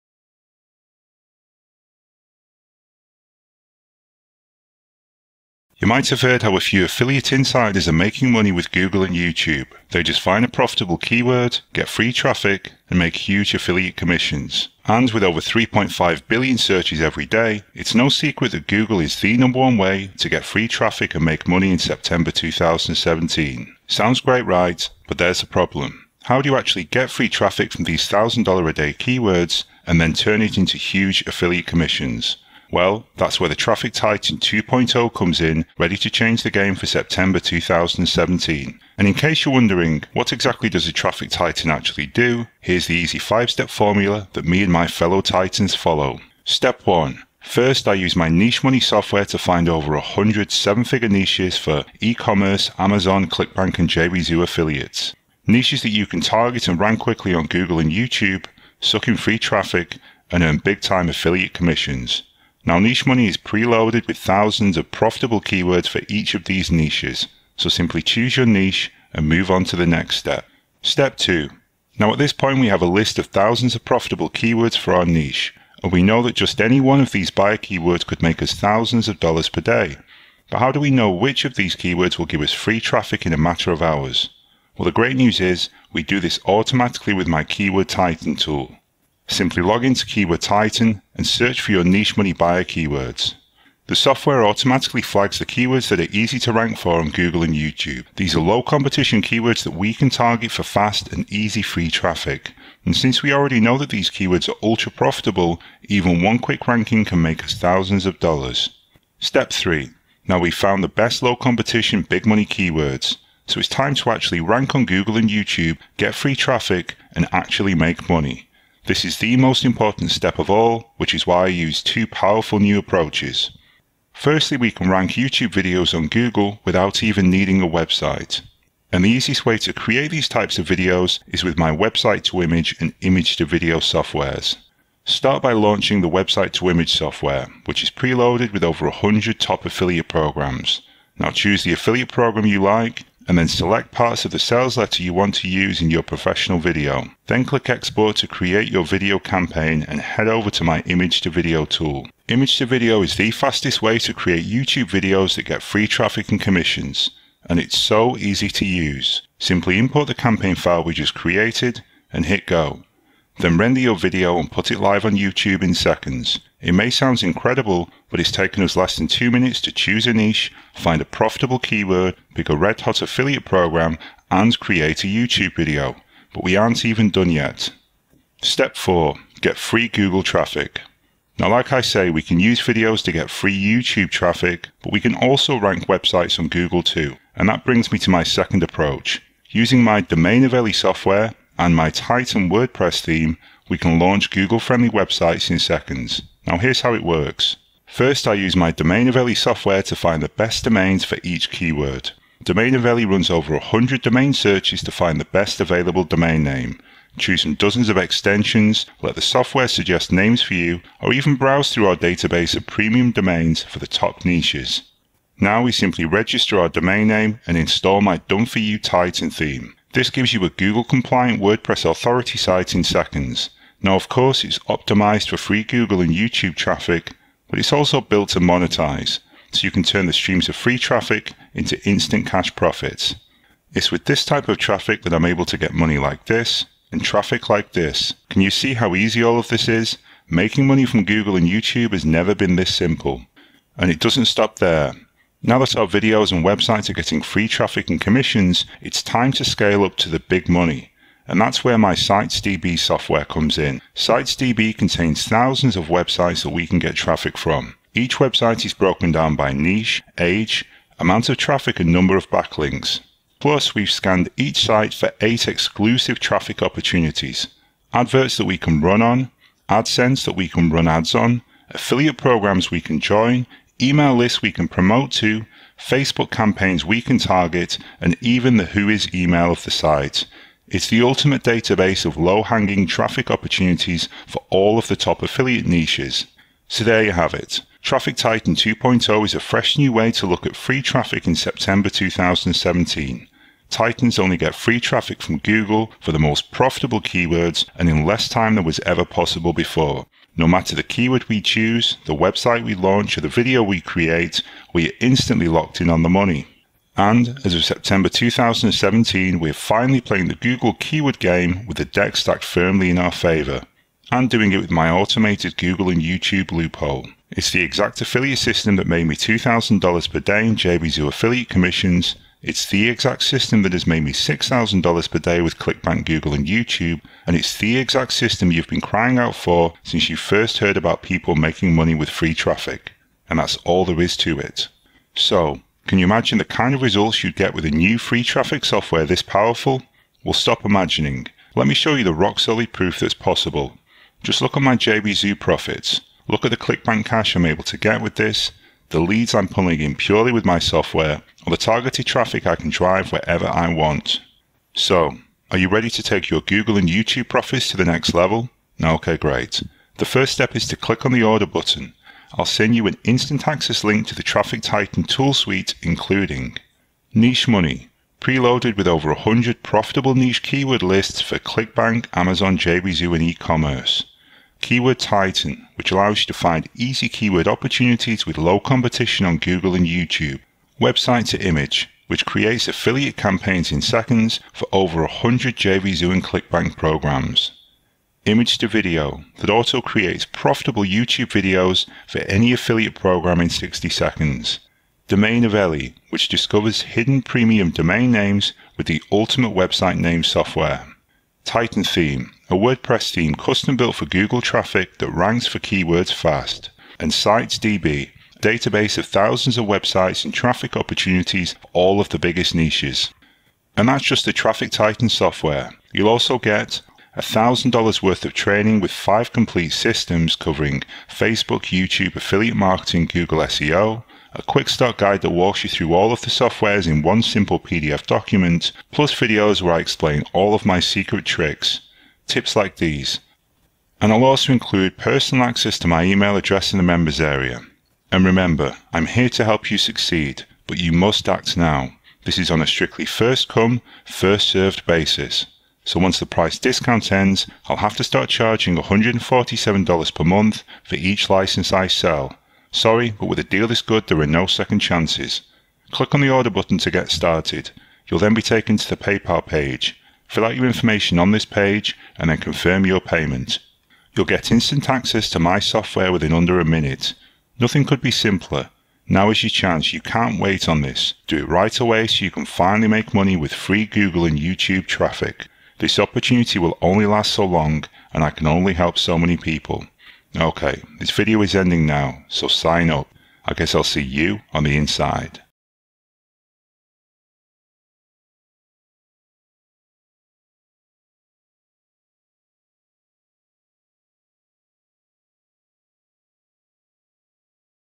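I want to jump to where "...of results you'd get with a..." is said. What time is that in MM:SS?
05:36.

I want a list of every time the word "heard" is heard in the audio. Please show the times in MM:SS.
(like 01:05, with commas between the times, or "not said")
00:06, 05:30.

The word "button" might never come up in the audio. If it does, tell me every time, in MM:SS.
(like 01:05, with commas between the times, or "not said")
06:01, 07:36.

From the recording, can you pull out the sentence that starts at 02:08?
And the easiest way to create these types of videos is with my website to image and image to video softwares.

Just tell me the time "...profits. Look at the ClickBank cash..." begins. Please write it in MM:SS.
05:45.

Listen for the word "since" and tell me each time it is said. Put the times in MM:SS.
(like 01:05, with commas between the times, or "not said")
01:42, 05:29.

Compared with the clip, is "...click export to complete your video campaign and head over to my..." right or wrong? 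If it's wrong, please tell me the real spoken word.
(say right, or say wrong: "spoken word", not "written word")
wrong: "create", not "complete".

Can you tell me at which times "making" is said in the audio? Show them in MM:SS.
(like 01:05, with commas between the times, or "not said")
00:07, 04:00, 05:31.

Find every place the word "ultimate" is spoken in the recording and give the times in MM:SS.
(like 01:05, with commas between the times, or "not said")
04:41, 06:39.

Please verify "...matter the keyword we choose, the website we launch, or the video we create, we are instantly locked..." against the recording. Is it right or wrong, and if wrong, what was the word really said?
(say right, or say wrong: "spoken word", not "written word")
right.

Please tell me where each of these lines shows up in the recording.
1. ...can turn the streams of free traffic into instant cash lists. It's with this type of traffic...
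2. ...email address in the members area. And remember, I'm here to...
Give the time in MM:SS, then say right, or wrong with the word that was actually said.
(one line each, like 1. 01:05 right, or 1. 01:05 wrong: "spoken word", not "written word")
1. 03:49 wrong: "profits", not "lists"
2. 07:16 right.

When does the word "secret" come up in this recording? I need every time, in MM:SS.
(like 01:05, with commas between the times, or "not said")
00:18, 07:10.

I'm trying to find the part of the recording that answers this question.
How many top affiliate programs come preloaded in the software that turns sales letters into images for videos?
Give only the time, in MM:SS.
02:18.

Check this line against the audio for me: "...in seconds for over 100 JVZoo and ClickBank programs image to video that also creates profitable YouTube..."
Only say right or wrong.
right.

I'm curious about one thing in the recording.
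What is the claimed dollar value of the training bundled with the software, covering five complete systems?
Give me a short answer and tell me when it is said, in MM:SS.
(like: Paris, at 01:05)
$1,000, at 06:57.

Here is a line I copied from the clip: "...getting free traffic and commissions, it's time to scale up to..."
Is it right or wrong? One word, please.
right.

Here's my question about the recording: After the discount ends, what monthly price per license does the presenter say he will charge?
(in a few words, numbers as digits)
$147.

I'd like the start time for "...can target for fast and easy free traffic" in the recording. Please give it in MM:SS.
01:39.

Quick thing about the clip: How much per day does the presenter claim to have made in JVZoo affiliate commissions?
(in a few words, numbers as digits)
$2,000.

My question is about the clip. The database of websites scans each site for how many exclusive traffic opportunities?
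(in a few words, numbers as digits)
8.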